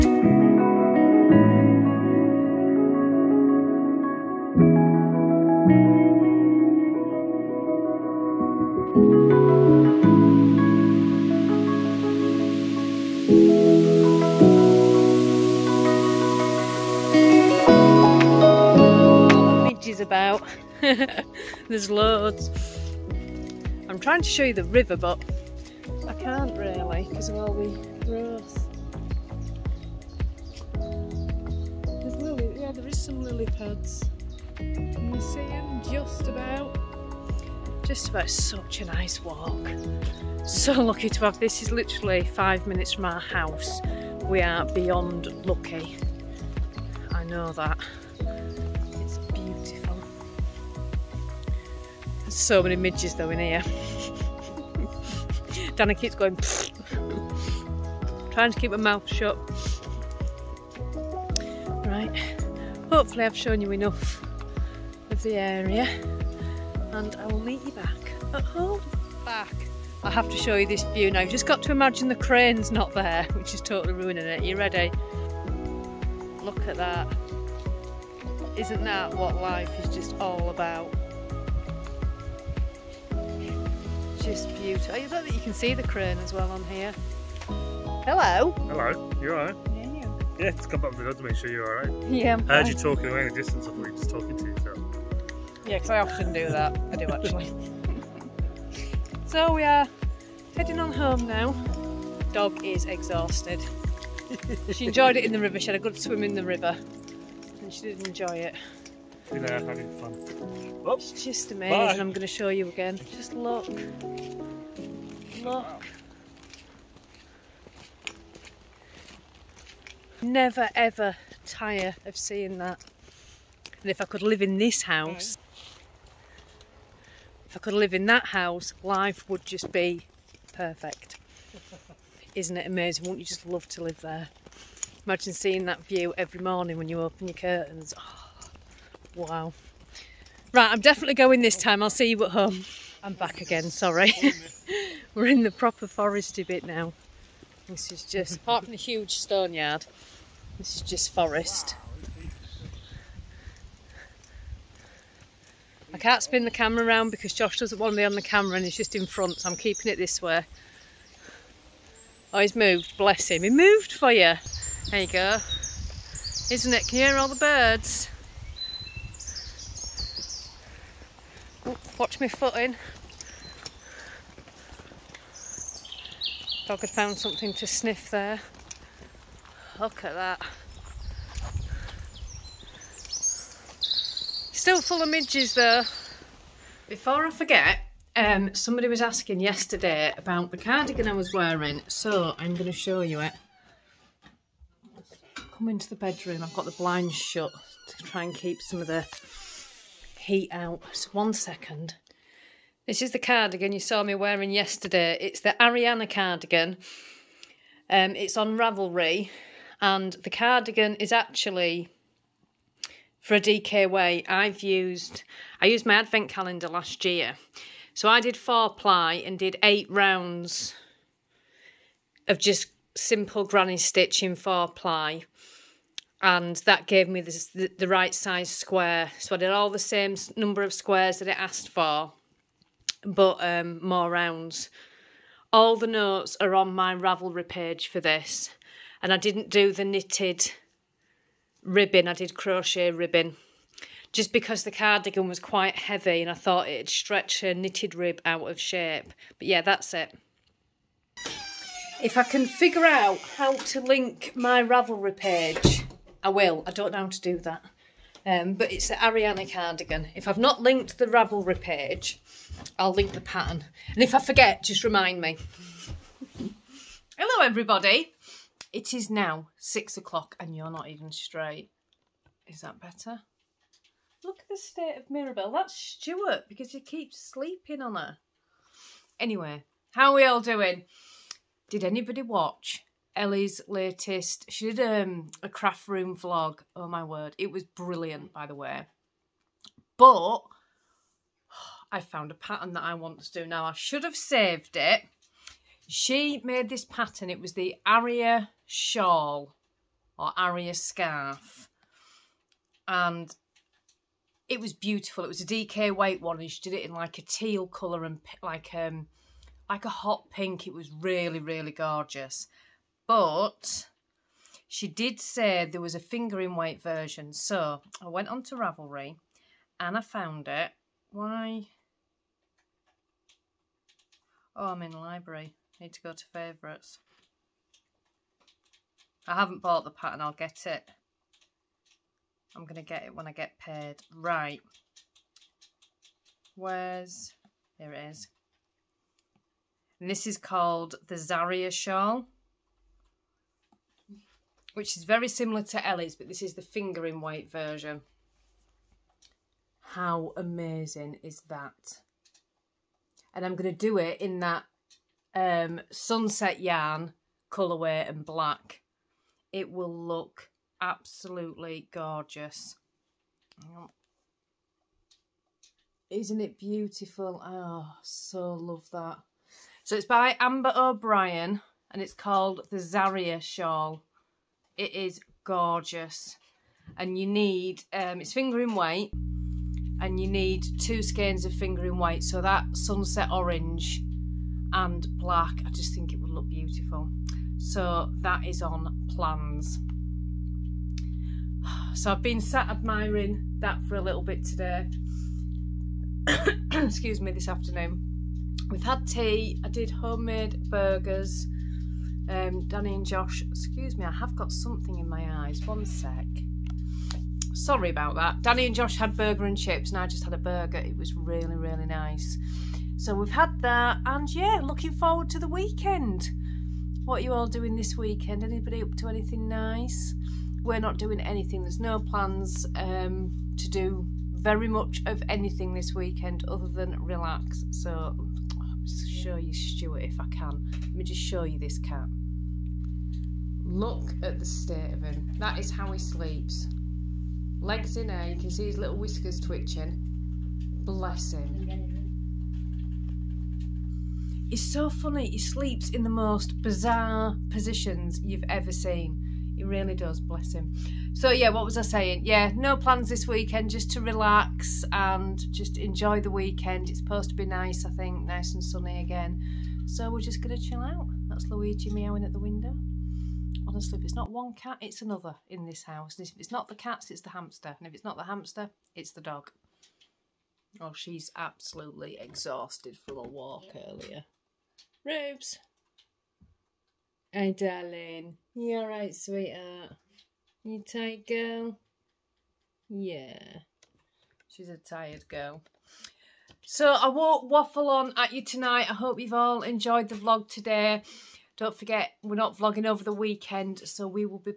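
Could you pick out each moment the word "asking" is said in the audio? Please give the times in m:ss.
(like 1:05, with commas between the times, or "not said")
3:09.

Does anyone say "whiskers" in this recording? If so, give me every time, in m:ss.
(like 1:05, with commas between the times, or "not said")
7:18.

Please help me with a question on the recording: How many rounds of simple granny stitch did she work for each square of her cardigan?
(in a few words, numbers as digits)
8.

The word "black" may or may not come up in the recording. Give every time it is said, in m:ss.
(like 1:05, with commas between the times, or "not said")
5:58, 6:25.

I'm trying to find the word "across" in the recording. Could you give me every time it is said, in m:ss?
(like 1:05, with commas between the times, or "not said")
not said.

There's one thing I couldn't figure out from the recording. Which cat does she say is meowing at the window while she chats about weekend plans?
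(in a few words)
Luigi.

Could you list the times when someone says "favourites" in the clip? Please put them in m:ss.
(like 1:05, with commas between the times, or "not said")
5:26.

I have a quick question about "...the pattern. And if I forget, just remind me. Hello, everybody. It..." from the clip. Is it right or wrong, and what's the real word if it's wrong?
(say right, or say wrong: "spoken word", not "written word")
right.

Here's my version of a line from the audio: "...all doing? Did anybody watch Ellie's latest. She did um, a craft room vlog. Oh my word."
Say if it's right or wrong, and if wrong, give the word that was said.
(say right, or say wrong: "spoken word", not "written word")
right.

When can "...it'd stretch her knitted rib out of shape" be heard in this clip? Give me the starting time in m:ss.
4:06.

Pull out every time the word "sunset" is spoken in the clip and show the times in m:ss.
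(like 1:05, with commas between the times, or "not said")
5:55, 6:22.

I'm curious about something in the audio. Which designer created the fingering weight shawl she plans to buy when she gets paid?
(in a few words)
Amber O'Brien.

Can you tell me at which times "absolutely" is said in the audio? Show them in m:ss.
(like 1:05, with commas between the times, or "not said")
6:00, 7:51.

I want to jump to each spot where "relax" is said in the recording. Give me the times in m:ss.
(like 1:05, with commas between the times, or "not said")
7:07, 7:34.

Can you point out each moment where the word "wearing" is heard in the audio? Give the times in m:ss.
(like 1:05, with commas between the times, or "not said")
3:11, 3:24.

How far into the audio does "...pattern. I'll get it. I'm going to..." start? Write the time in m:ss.
5:29.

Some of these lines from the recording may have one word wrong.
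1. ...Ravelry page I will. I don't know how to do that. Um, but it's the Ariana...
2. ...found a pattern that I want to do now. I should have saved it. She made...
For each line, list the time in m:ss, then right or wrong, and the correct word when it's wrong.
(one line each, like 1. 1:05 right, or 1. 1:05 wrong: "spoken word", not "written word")
1. 4:14 right
2. 4:52 right.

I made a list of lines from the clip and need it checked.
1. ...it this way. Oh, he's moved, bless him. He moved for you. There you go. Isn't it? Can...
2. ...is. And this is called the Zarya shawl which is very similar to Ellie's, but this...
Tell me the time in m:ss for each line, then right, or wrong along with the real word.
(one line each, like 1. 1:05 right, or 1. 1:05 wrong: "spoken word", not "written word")
1. 2:39 right
2. 5:38 right.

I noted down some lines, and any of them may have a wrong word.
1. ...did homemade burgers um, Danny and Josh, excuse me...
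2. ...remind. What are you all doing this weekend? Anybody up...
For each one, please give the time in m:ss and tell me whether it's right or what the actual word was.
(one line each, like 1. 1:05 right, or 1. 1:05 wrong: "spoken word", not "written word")
1. 6:39 right
2. 6:55 wrong: "weekend", not "remind".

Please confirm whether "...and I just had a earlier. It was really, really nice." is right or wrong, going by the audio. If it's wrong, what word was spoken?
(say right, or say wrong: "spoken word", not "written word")
wrong: "burger", not "earlier".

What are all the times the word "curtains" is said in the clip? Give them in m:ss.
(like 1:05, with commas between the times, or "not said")
2:17.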